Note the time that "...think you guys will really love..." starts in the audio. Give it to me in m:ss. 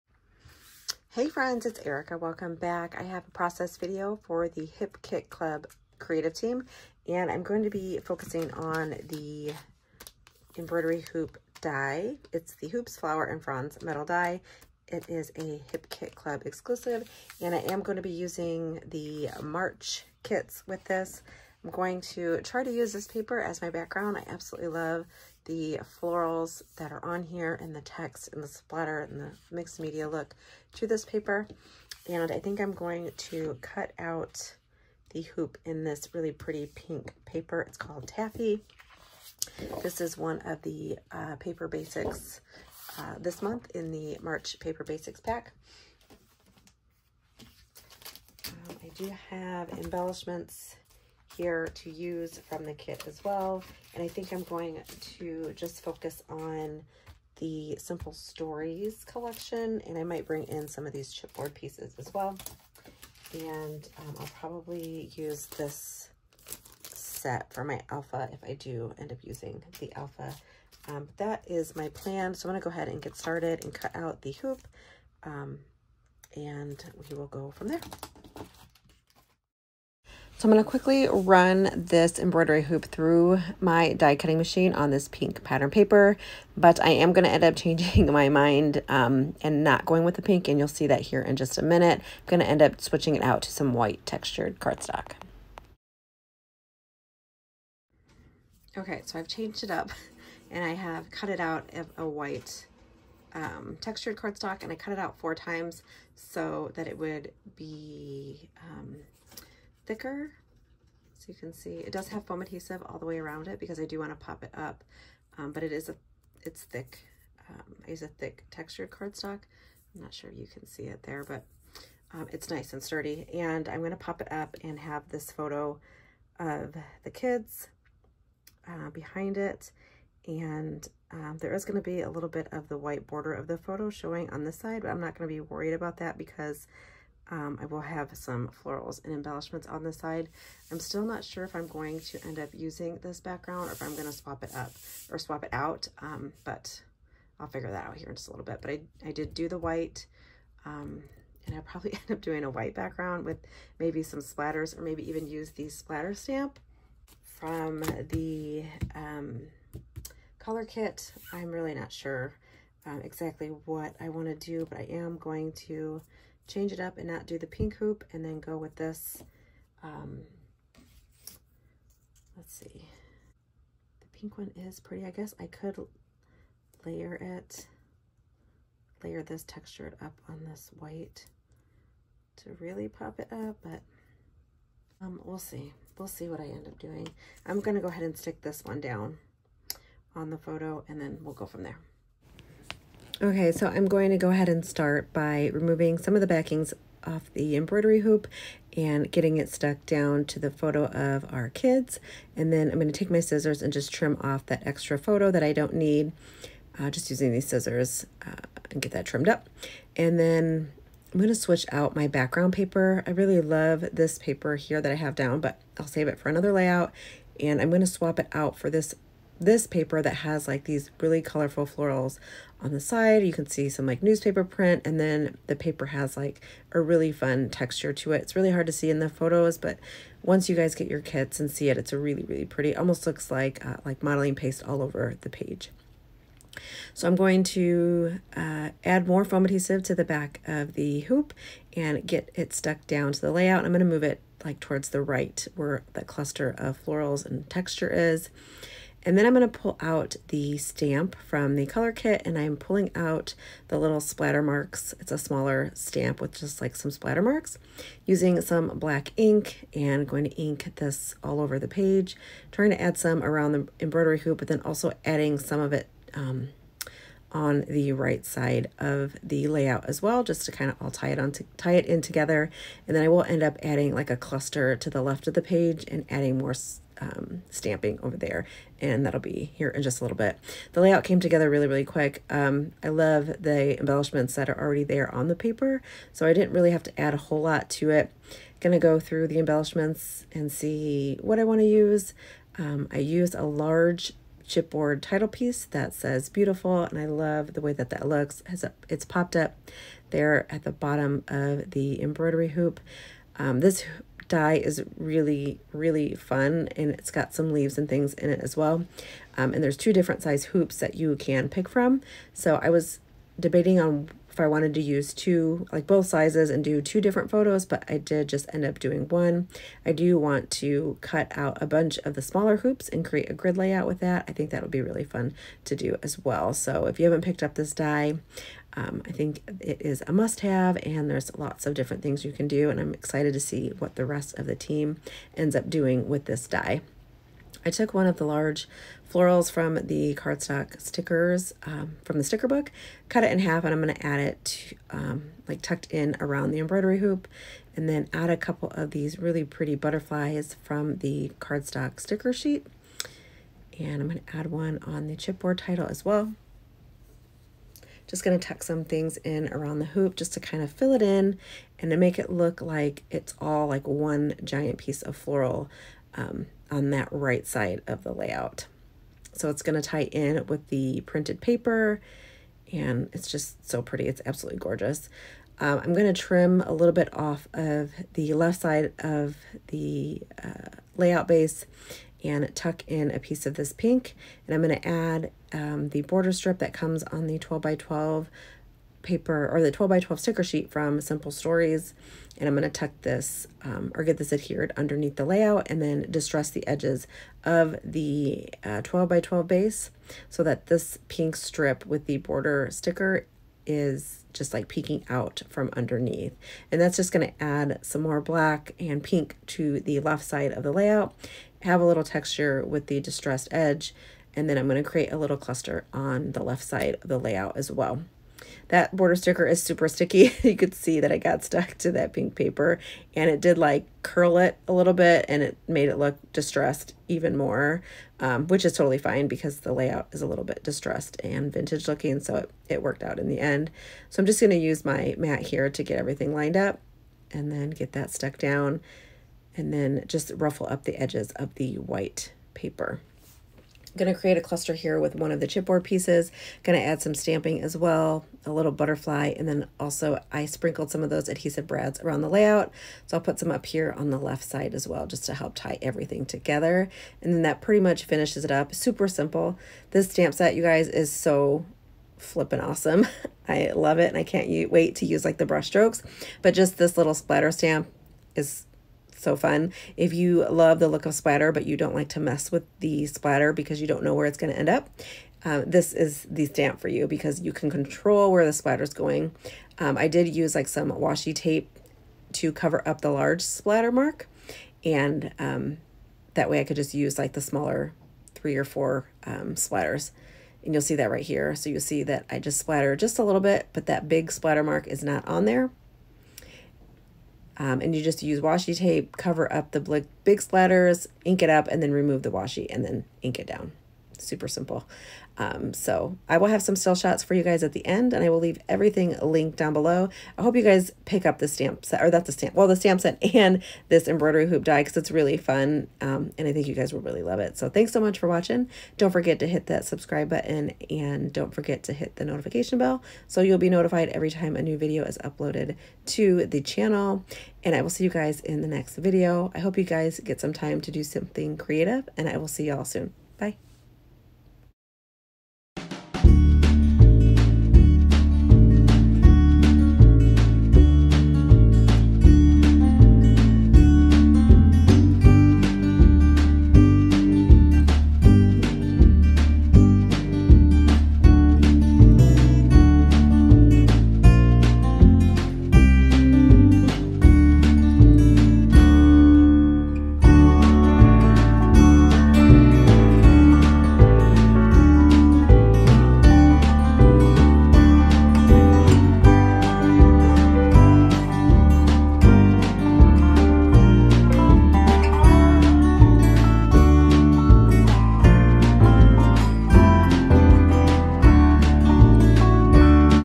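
8:36.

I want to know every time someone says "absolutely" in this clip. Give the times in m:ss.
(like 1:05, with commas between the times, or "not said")
0:24, 6:14.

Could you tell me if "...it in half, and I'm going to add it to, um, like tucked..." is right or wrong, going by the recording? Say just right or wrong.
right.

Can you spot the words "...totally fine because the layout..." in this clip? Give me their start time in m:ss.
7:08.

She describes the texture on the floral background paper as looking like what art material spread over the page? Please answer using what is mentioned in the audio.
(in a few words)
modeling paste.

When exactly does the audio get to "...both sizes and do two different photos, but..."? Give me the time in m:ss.
5:15.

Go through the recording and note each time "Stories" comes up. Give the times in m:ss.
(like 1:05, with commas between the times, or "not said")
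0:58, 6:31.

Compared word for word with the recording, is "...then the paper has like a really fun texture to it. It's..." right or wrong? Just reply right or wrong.
right.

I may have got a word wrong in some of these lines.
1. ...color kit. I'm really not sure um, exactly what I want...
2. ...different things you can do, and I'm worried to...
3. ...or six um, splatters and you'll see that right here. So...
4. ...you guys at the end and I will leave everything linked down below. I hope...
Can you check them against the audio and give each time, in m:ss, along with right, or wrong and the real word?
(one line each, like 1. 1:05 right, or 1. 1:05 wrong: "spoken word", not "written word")
1. 2:40 right
2. 5:31 wrong: "excited", not "worried"
3. 8:08 wrong: "four", not "six"
4. 8:27 right.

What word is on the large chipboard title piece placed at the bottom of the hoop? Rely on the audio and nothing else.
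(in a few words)
beautiful.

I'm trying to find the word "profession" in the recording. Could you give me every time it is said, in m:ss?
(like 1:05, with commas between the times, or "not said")
not said.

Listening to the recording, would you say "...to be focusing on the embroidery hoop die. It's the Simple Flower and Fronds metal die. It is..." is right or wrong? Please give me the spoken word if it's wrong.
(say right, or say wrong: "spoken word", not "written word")
wrong: "Hoops", not "Simple".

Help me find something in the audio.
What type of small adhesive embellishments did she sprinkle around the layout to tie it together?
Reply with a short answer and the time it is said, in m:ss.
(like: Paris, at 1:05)
adhesive brads, at 7:31.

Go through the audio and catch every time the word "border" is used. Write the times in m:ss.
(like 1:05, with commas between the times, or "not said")
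2:13, 6:26, 6:42, 6:58.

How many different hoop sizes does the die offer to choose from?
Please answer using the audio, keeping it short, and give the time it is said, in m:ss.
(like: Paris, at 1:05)
2, at 5:09.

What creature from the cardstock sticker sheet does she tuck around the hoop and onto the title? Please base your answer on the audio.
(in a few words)
butterflies.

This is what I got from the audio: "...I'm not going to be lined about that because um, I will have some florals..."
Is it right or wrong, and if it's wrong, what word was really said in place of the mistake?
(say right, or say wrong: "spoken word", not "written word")
wrong: "worried", not "lined".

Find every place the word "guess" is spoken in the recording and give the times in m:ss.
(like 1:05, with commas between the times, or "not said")
2:55.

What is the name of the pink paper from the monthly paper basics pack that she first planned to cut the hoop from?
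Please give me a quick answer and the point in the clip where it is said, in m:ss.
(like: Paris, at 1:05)
Taffy, at 0:38.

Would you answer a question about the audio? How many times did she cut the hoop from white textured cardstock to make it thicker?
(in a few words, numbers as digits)
4.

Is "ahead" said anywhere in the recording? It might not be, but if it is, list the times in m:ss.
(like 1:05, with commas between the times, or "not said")
1:12, 3:07, 3:14.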